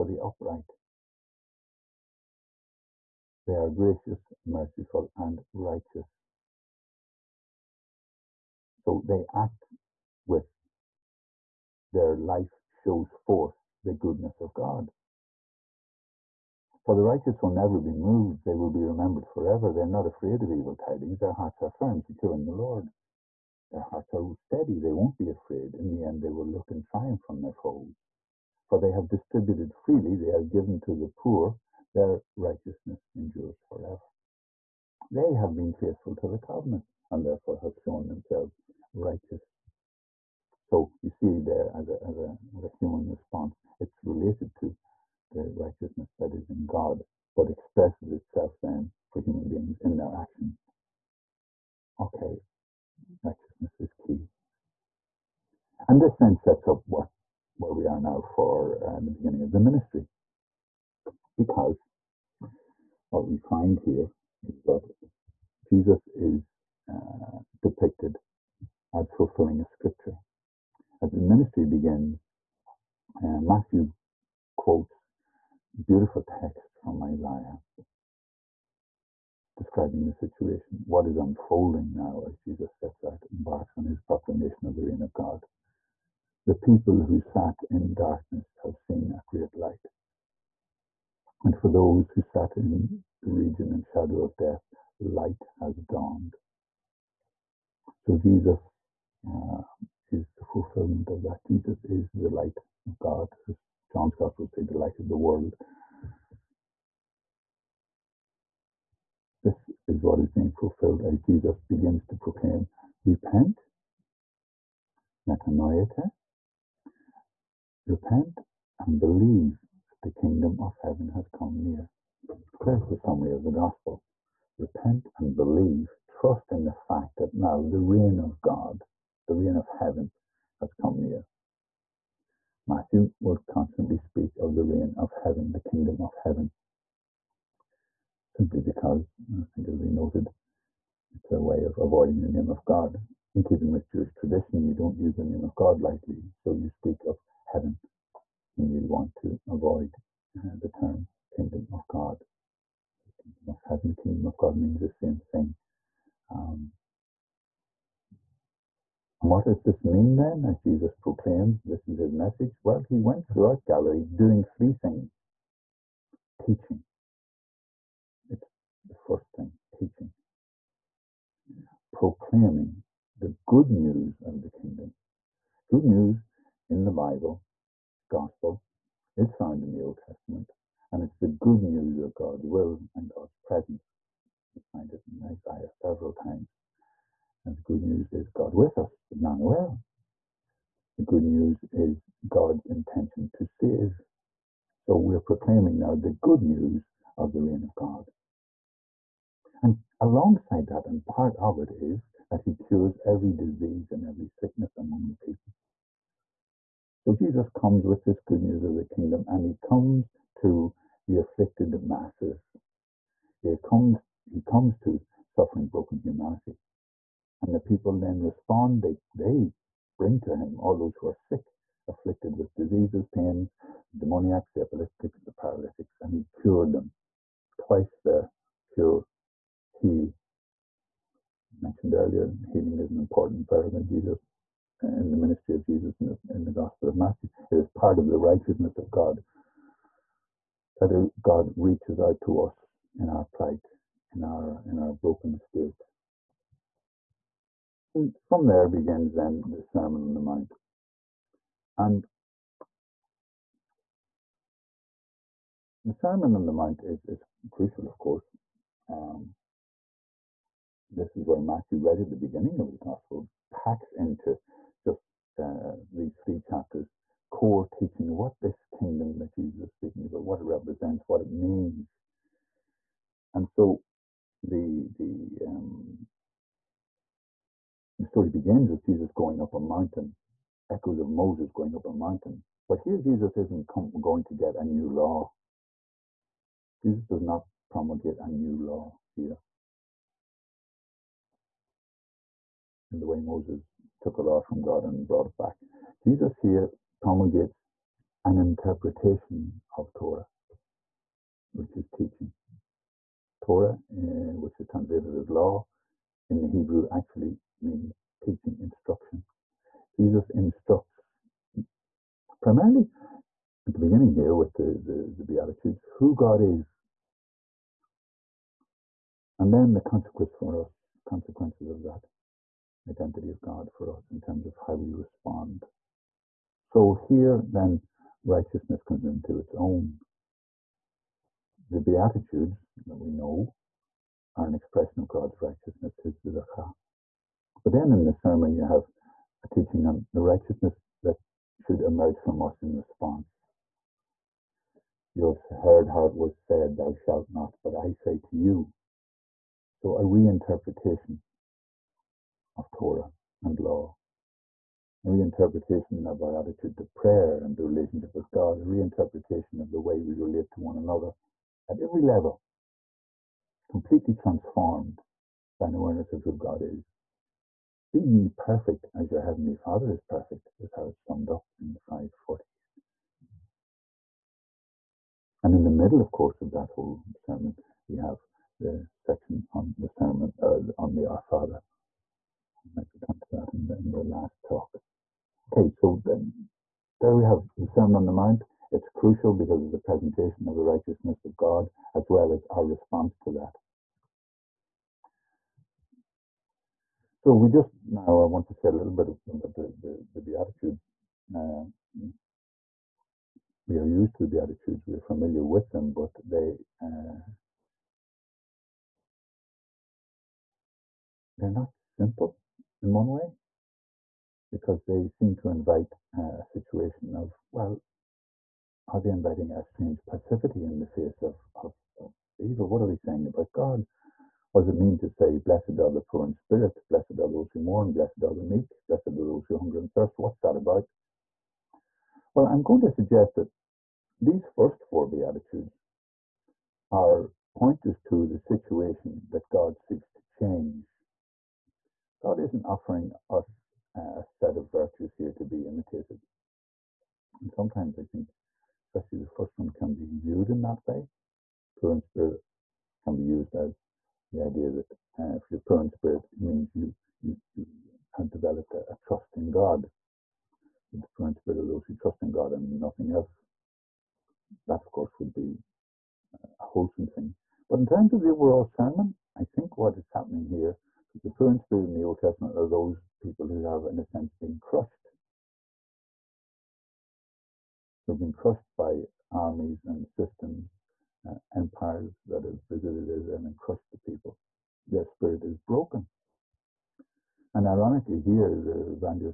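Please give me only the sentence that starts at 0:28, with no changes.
For they have distributed freely, they have given to the poor, their righteousness endures forever.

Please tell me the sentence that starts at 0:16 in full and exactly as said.
For the righteous will never be moved, they will be remembered forever.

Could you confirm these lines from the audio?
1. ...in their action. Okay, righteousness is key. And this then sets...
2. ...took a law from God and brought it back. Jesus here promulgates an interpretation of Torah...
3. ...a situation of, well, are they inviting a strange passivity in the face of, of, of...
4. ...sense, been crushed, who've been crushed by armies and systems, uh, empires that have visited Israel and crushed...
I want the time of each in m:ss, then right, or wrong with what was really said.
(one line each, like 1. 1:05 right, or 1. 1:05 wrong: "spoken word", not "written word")
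1. 0:49 right
2. 4:53 right
3. 6:56 right
4. 7:54 right.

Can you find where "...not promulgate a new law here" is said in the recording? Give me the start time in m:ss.
4:47.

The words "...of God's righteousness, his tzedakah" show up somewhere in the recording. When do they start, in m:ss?
5:35.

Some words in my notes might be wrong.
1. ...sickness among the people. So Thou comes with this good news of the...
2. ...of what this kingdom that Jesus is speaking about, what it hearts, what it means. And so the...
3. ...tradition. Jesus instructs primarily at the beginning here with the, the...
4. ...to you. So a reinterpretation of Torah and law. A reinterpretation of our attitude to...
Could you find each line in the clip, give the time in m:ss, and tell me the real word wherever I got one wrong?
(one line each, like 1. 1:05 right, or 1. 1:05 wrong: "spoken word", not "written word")
1. 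3:24 wrong: "Jesus", not "Thou"
2. 4:28 wrong: "represents", not "hearts"
3. 5:08 wrong: "instruction", not "tradition"
4. 5:48 right.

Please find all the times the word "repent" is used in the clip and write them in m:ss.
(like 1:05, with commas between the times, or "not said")
1:53, 1:57, 2:04.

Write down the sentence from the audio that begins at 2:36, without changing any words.
Um, what does this mean then, as Jesus proclaims this is his message?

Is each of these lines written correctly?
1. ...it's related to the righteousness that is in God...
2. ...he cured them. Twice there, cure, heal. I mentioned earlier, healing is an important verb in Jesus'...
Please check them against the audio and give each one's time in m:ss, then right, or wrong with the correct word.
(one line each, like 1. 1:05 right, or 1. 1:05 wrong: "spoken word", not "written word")
1. 0:43 right
2. 3:46 right.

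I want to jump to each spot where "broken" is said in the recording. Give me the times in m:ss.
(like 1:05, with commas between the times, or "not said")
3:35, 4:04, 8:05.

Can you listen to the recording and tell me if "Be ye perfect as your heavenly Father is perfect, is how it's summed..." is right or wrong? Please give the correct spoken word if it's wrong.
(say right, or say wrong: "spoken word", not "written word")
right.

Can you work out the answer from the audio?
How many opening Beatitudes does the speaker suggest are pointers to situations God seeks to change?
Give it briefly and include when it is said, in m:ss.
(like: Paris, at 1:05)
4, at 7:14.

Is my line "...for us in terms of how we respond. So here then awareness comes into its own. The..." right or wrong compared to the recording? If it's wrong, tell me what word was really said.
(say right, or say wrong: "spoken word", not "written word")
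wrong: "righteousness", not "awareness".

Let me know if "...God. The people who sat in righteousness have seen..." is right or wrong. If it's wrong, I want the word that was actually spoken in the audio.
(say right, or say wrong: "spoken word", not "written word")
wrong: "darkness", not "righteousness".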